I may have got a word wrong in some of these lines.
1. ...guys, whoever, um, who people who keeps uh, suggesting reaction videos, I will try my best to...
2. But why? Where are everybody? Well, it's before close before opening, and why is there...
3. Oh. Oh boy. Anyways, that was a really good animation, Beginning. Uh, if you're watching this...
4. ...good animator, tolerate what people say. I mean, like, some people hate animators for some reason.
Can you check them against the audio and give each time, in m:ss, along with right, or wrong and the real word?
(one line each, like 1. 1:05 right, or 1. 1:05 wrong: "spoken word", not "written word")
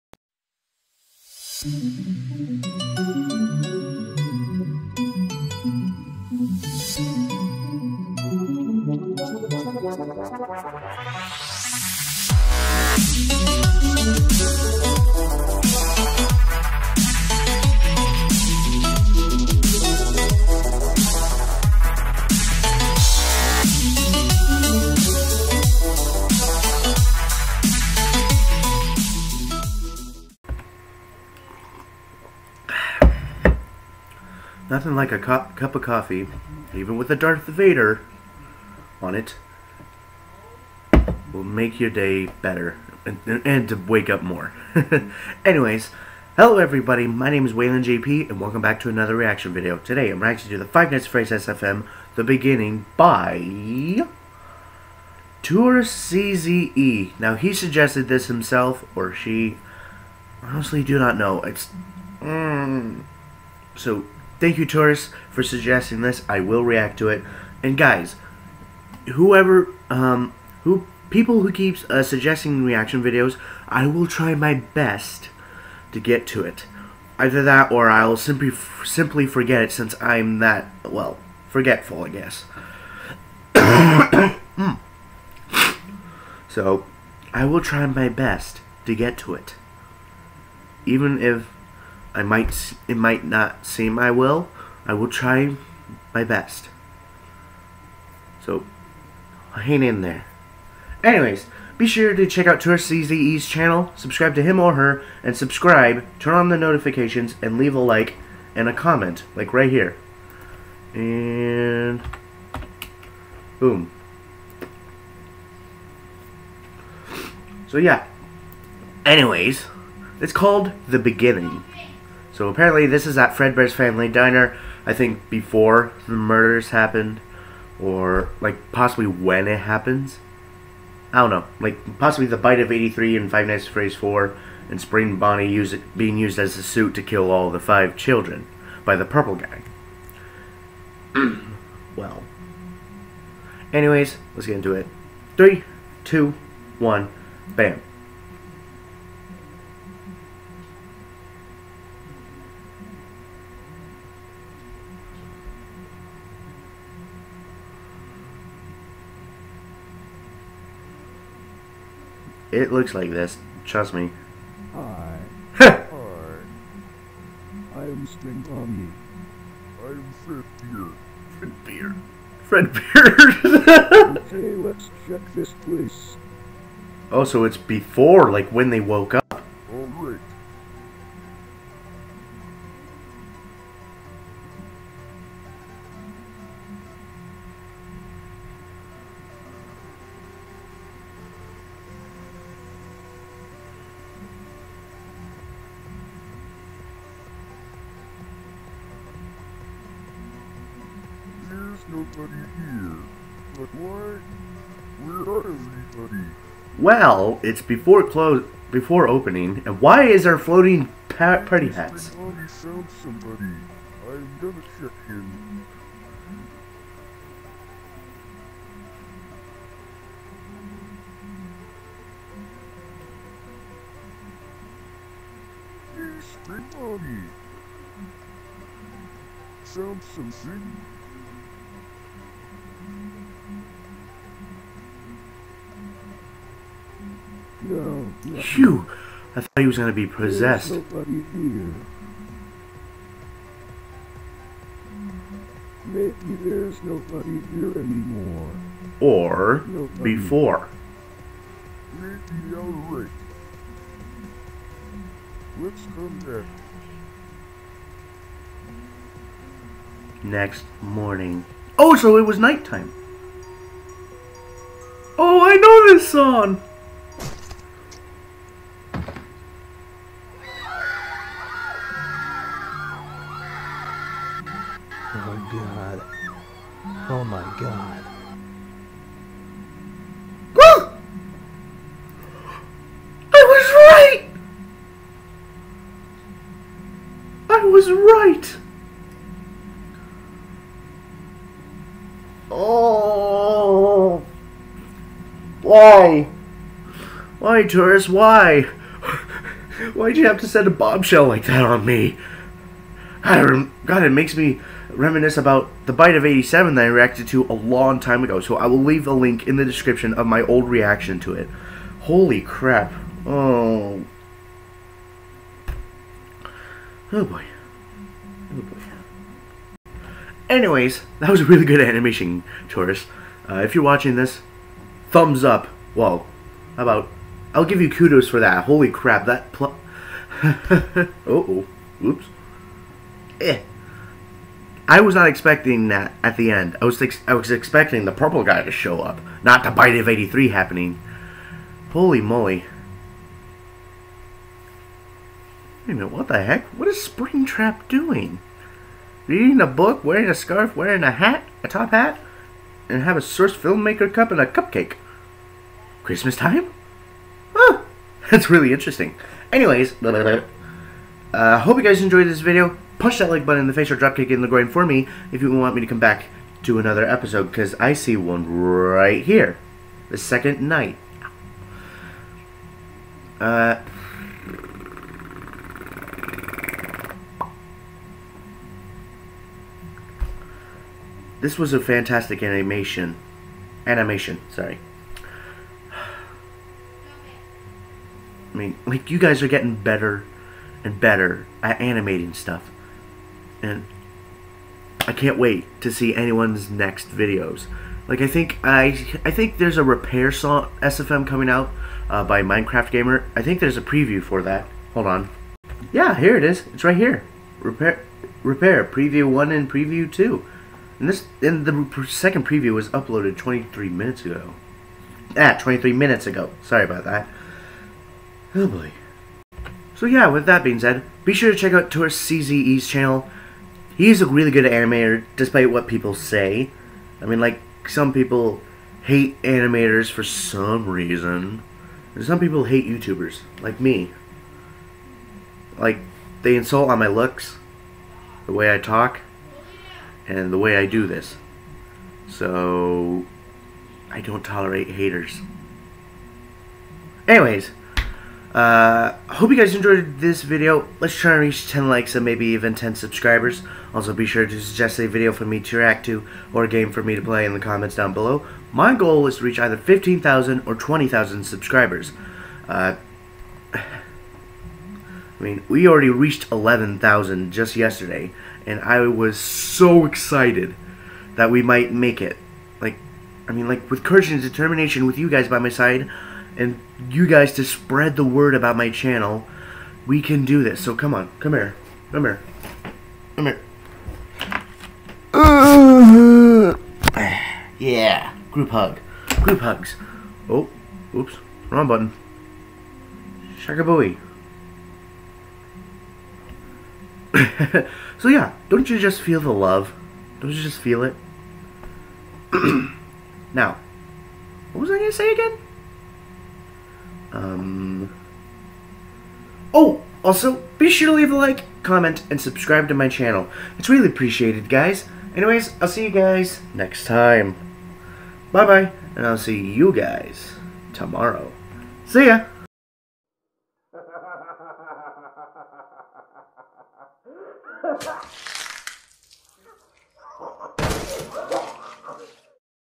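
1. 1:07 right
2. 3:23 right
3. 5:13 wrong: "Touris", not "Beginning"
4. 7:04 wrong: "despite", not "tolerate".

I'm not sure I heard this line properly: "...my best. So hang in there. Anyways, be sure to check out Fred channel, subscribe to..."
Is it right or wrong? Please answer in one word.
wrong.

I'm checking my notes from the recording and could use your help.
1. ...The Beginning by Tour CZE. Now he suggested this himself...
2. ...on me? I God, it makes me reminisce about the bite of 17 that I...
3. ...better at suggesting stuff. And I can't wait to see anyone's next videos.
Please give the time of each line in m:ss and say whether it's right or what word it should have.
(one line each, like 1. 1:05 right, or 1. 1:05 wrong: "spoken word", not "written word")
1. 0:52 right
2. 5:01 wrong: "87", not "17"
3. 6:30 wrong: "animating", not "suggesting".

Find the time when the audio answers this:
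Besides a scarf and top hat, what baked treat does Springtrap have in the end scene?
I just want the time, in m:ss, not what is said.
5:54.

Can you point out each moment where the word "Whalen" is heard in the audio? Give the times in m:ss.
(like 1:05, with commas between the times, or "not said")
0:47.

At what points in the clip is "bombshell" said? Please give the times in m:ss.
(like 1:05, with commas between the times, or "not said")
5:00.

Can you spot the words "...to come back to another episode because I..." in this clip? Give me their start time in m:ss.
6:05.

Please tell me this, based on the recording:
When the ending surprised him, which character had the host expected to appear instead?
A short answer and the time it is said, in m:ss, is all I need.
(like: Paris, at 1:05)
the purple guy, at 5:38.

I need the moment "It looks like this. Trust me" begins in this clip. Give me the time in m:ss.
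2:42.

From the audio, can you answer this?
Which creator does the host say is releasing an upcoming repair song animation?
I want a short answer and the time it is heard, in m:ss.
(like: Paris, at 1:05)
Minecraft Gamer, at 6:42.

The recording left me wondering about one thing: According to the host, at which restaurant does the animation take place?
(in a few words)
Fredbear's Family Diner.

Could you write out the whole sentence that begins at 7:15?
Like, they insult on my looks, the way I talk, and the way I do this.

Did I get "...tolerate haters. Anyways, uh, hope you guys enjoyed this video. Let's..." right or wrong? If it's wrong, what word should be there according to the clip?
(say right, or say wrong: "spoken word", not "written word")
right.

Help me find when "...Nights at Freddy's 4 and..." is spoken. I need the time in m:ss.
2:13.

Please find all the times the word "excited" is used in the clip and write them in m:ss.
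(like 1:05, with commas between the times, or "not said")
7:50.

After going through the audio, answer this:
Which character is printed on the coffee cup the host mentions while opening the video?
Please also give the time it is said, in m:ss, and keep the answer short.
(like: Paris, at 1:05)
Darth Vader, at 0:37.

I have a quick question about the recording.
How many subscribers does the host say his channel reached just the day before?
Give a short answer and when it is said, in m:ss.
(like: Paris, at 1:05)
11,000, at 7:46.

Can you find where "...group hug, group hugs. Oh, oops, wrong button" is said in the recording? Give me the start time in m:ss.
8:08.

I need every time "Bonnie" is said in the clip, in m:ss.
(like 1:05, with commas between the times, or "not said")
2:15.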